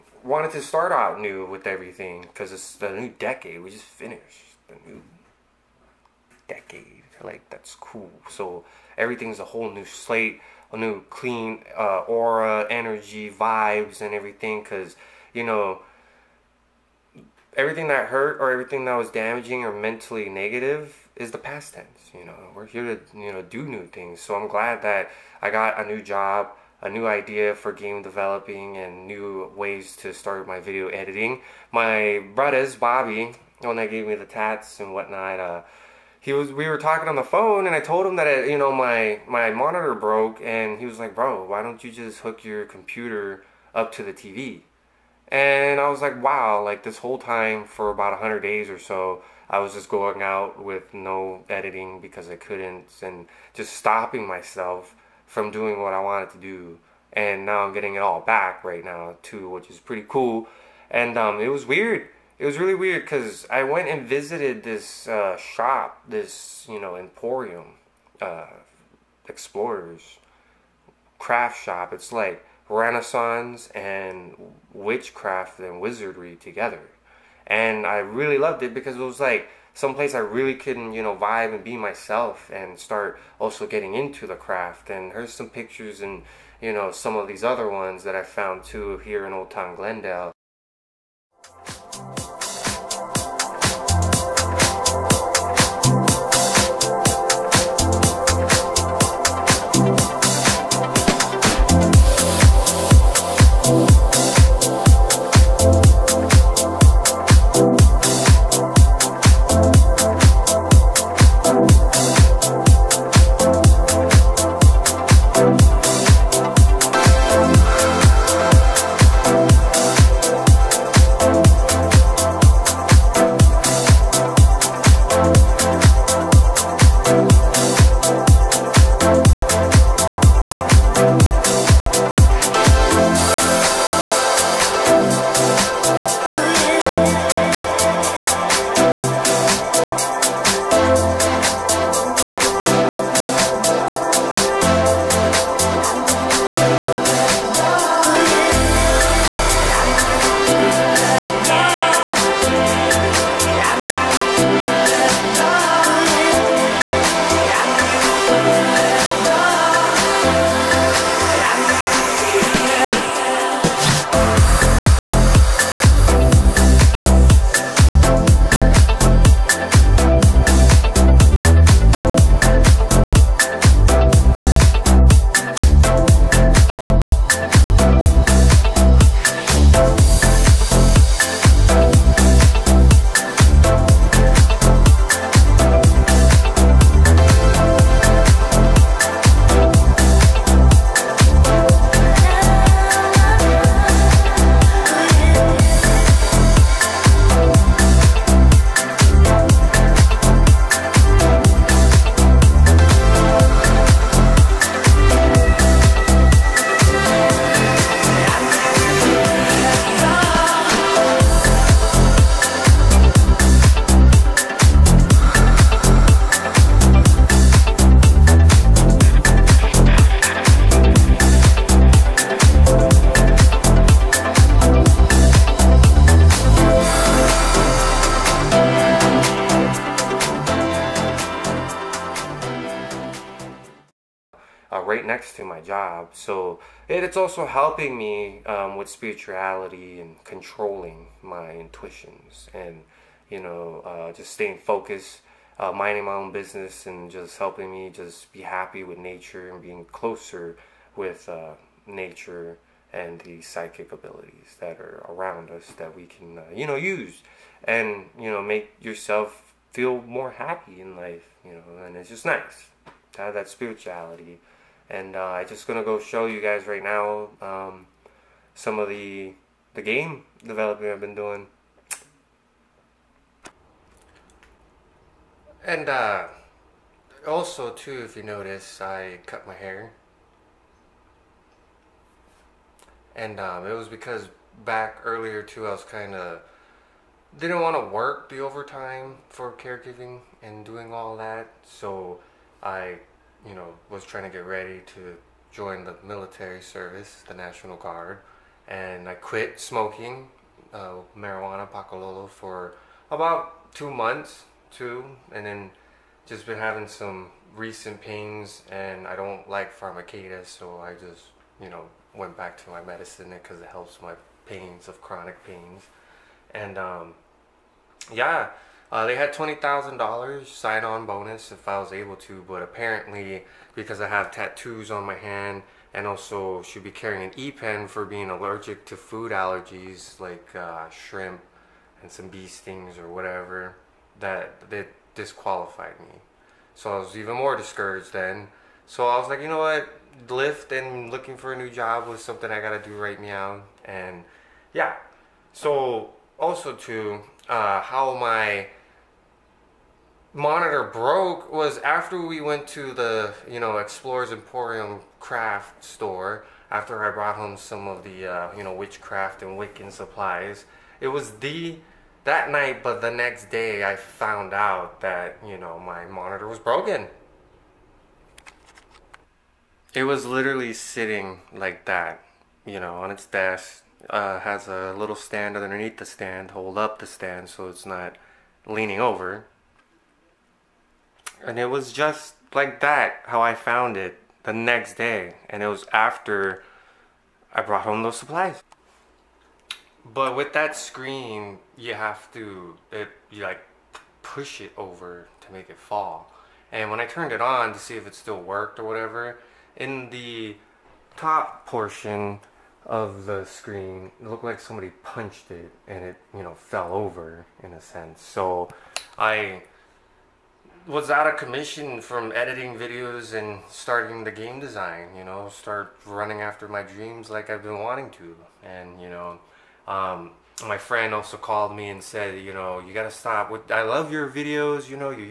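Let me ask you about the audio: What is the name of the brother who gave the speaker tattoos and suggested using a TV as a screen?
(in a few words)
Bobby.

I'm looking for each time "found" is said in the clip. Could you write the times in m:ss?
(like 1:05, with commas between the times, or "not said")
1:28, 6:03, 6:23.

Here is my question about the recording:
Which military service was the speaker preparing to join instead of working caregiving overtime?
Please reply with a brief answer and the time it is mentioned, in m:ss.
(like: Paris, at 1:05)
National Guard, at 4:57.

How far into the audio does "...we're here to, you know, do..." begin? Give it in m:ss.
0:22.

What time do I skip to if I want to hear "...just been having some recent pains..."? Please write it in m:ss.
5:06.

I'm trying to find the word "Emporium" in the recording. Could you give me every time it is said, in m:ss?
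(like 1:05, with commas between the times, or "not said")
1:06, 5:54.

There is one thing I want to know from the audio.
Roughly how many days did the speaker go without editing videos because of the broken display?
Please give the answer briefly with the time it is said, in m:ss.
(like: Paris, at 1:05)
100, at 0:48.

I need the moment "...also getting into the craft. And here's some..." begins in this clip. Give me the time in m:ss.
1:23.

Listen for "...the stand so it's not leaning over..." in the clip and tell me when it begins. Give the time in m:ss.
6:16.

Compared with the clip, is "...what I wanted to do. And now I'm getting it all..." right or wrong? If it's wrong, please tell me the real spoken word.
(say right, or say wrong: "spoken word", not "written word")
right.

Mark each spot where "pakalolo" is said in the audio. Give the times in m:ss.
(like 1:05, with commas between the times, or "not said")
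5:01.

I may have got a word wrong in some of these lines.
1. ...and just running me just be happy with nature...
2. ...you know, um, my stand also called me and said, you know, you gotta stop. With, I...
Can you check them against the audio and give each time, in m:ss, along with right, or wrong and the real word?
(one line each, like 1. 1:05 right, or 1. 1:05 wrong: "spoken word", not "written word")
1. 4:06 wrong: "helping", not "running"
2. 6:58 wrong: "friend", not "stand".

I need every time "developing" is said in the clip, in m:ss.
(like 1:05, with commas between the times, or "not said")
0:28, 4:30.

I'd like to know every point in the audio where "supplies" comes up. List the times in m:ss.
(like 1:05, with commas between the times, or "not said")
5:59, 6:28.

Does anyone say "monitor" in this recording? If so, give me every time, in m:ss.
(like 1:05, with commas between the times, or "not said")
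0:39, 5:50, 6:06.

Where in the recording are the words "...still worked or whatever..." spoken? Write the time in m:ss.
6:38.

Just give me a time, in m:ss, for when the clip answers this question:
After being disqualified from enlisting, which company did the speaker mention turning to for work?
5:40.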